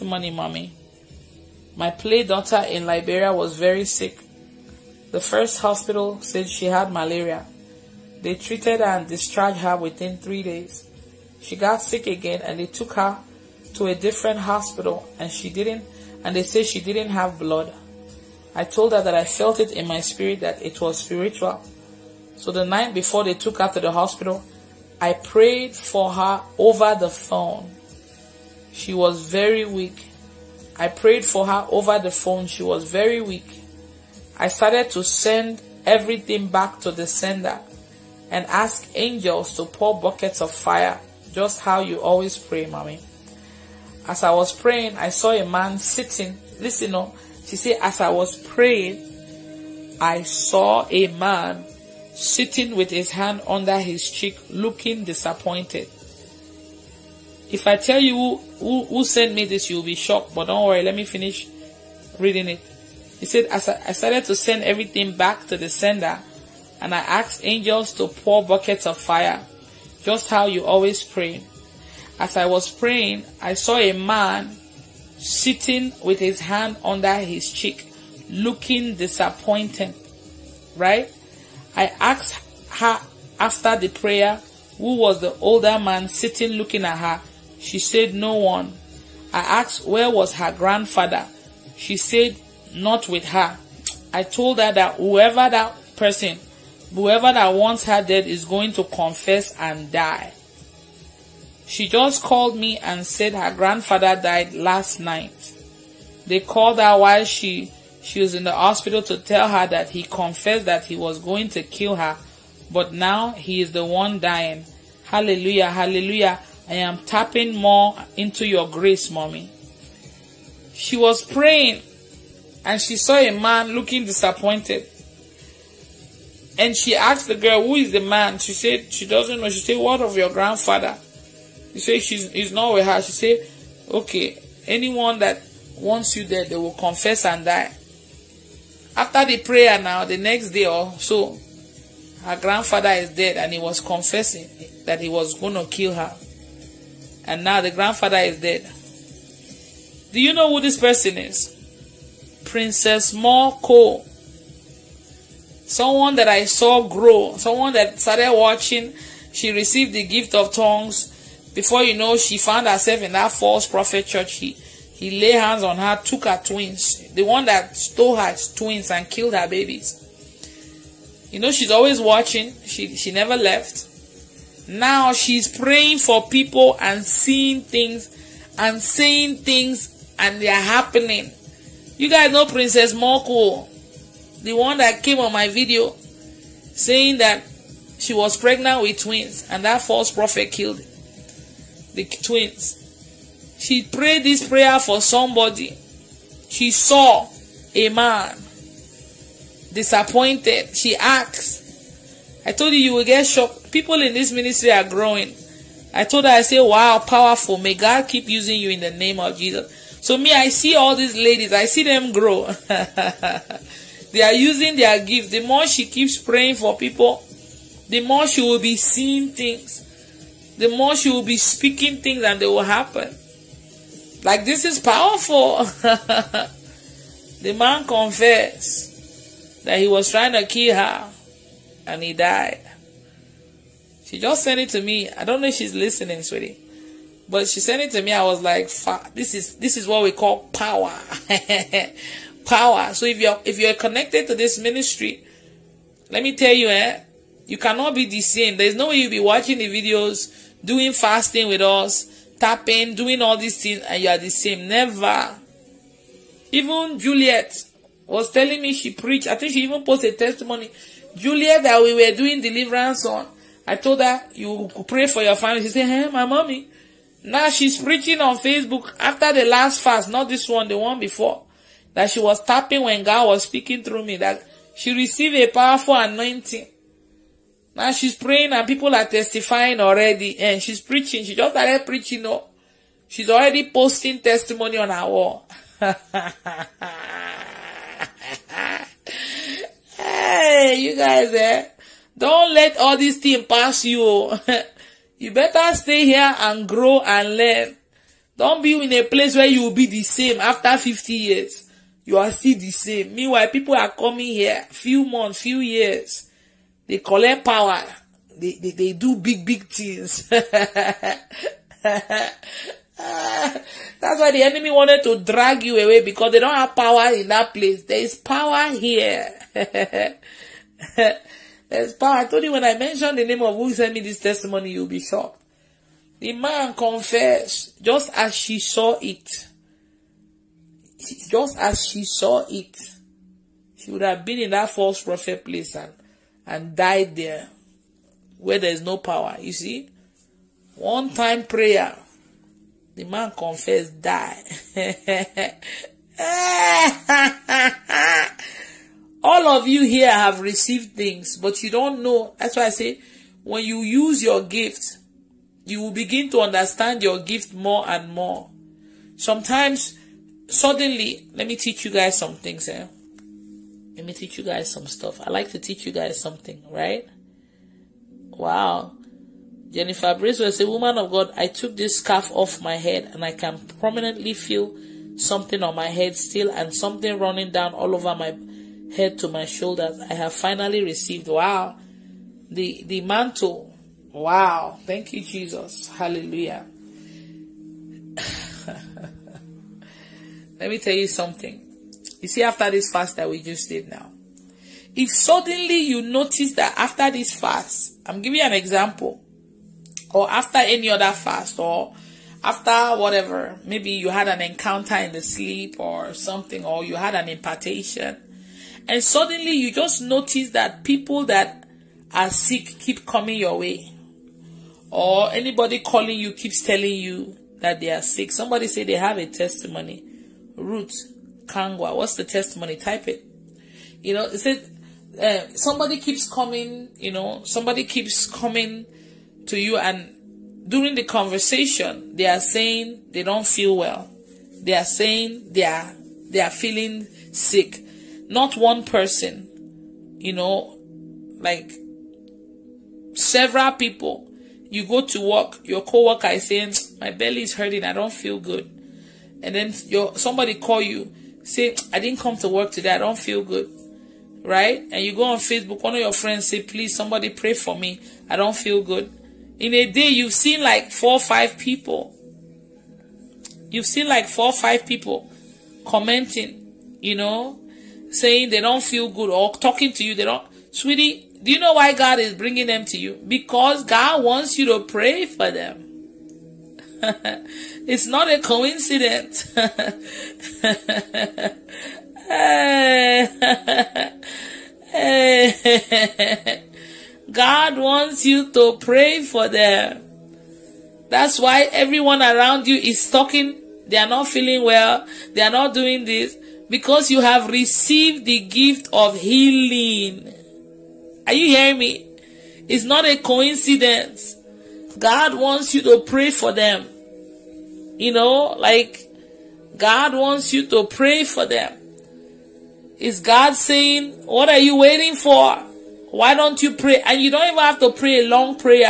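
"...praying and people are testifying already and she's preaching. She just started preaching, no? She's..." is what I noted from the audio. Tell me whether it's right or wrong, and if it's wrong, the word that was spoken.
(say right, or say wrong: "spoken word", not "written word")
right.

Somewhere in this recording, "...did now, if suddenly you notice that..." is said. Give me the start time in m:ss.
6:33.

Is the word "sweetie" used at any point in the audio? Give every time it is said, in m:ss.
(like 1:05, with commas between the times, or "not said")
3:56, 7:50.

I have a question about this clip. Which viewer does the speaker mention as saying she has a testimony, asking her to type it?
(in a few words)
Ruth Kangwa.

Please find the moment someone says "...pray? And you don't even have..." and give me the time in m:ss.
8:36.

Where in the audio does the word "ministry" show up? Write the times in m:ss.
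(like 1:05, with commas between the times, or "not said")
3:24, 4:04.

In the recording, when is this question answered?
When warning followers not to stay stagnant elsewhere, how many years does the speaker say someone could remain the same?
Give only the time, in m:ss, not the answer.
5:00.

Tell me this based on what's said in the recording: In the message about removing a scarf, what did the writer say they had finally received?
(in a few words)
the mantle.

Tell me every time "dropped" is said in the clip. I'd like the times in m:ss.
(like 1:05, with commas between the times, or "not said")
not said.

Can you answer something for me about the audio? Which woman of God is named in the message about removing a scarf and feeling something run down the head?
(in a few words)
Jennifer Brace.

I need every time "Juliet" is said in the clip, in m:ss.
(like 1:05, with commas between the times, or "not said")
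4:16, 4:21.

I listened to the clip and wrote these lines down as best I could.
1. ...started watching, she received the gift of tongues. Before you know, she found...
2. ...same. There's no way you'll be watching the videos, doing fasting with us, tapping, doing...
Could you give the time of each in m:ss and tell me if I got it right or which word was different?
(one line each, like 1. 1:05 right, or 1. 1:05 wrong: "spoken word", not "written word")
1. 2:37 right
2. 4:08 right.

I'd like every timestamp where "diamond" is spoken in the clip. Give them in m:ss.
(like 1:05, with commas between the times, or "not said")
not said.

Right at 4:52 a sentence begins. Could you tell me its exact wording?
Don't let all these things pass you.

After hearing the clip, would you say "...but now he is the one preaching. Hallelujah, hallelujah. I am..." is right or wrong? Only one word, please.
wrong.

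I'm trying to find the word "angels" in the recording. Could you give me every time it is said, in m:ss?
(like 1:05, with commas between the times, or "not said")
0:38, 1:07.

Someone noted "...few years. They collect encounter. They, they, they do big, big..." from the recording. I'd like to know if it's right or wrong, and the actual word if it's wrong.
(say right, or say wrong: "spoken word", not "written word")
wrong: "power", not "encounter".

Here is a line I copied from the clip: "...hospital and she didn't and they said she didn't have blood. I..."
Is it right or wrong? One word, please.
right.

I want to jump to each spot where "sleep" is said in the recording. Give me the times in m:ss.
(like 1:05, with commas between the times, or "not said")
6:45.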